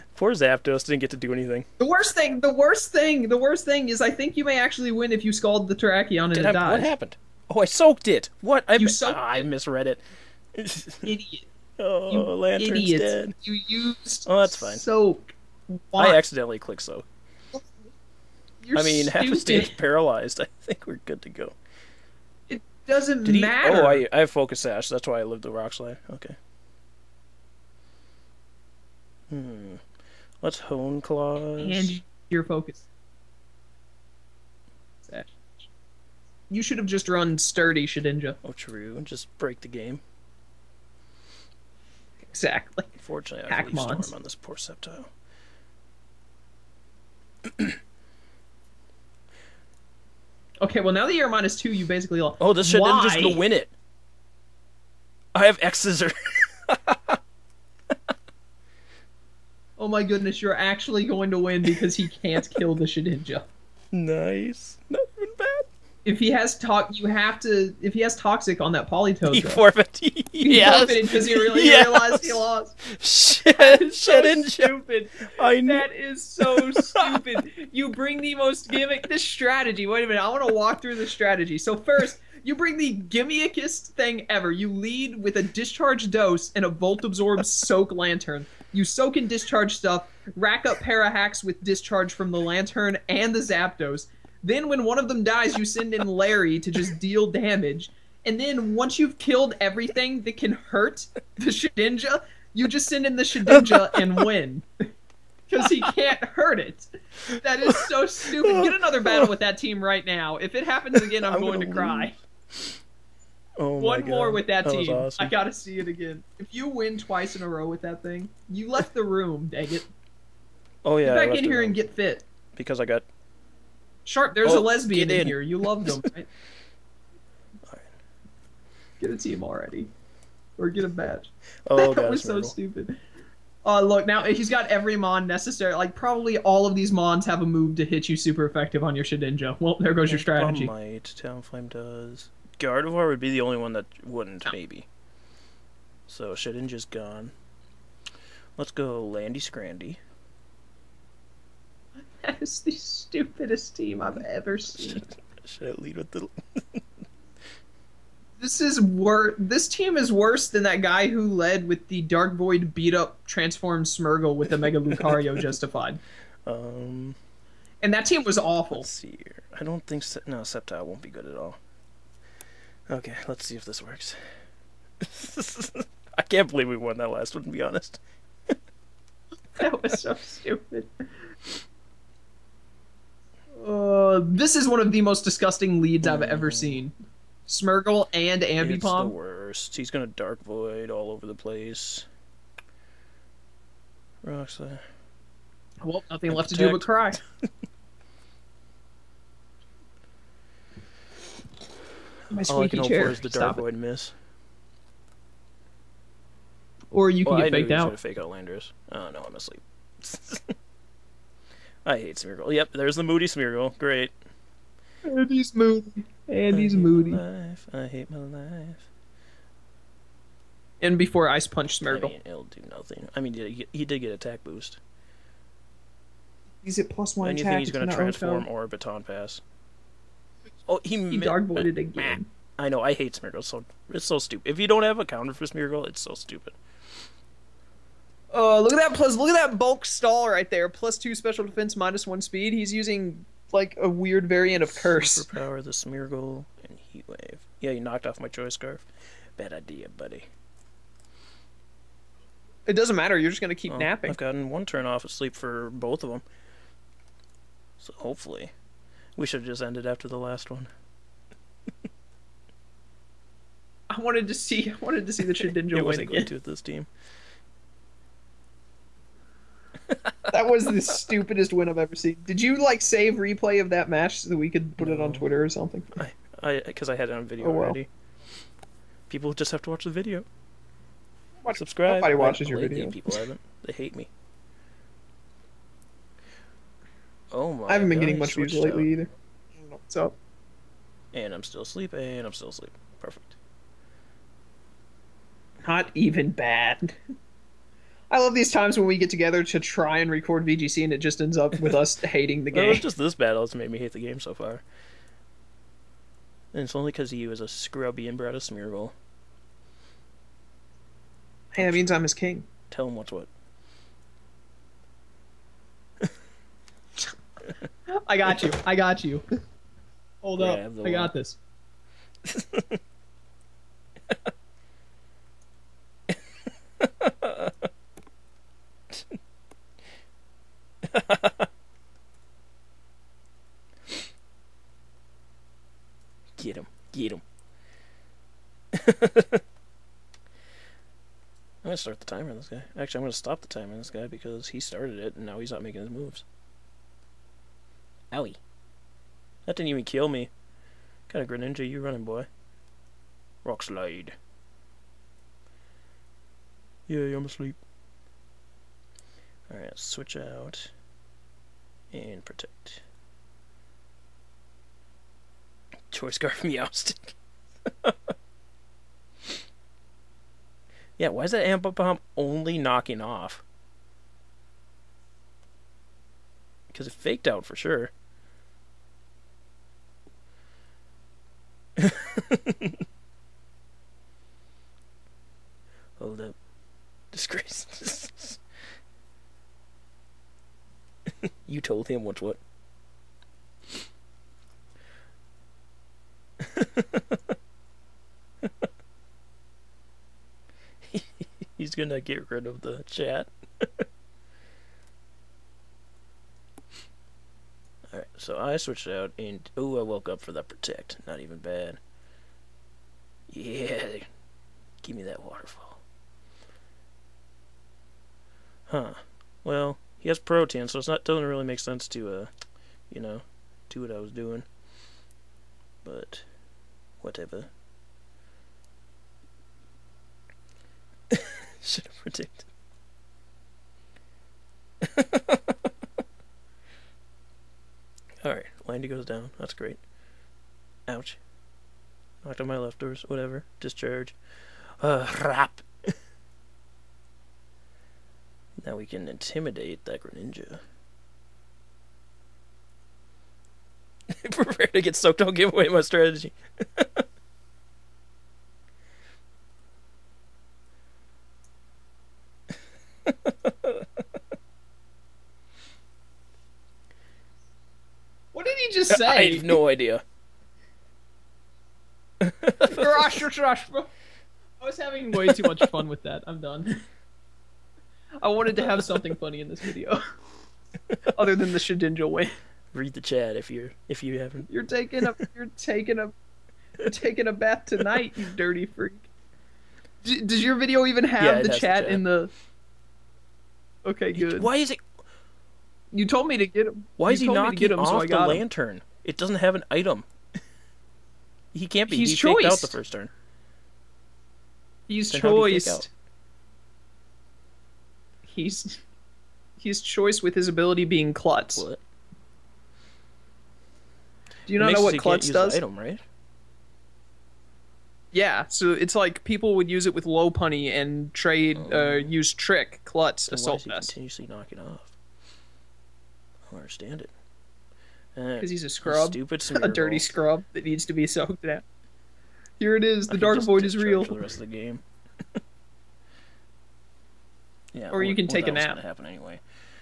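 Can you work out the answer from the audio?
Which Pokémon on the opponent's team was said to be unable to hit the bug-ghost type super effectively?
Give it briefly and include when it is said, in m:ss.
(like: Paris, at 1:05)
Gardevoir, at 2:22.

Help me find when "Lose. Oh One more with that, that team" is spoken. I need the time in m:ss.
1:52.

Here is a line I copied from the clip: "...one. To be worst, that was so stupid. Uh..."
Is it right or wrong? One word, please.
wrong.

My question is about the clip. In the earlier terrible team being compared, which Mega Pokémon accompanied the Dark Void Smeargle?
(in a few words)
Mega Lucario.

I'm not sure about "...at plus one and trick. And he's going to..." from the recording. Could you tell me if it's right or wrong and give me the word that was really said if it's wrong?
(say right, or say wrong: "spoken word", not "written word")
wrong: "attack", not "trick".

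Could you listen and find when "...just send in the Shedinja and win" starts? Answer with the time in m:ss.
1:42.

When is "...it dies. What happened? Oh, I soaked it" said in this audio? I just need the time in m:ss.
0:06.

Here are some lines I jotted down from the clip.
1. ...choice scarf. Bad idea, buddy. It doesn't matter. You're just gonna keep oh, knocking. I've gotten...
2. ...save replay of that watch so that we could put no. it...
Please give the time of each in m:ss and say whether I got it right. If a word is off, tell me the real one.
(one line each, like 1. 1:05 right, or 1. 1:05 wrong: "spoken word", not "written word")
1. 4:08 wrong: "napping", not "knocking"
2. 4:32 wrong: "match", not "watch".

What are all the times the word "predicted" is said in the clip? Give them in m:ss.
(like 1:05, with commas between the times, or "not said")
7:12.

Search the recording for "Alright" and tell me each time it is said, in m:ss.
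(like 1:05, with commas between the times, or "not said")
5:59, 6:47, 7:18.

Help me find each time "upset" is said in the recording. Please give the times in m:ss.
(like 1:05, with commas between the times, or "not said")
not said.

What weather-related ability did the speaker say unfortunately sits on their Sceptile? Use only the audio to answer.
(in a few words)
Storm.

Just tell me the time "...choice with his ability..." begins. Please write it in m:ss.
8:29.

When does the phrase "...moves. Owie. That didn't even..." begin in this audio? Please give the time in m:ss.
5:45.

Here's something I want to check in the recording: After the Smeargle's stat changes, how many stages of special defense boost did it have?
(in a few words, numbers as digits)
plus two.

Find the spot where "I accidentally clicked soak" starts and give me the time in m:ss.
0:16.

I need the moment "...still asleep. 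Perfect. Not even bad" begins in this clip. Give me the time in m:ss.
4:52.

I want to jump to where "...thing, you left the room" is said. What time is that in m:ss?
1:58.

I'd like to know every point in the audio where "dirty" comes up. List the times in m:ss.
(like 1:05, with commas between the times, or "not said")
8:08, 8:49.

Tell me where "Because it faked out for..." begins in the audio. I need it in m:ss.
6:16.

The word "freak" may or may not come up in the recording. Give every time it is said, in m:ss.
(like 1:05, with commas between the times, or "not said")
8:08.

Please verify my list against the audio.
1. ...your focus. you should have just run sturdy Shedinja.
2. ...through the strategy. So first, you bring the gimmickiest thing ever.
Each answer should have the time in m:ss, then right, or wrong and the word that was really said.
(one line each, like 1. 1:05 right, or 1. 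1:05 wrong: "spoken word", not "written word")
1. 0:32 right
2. 1:20 right.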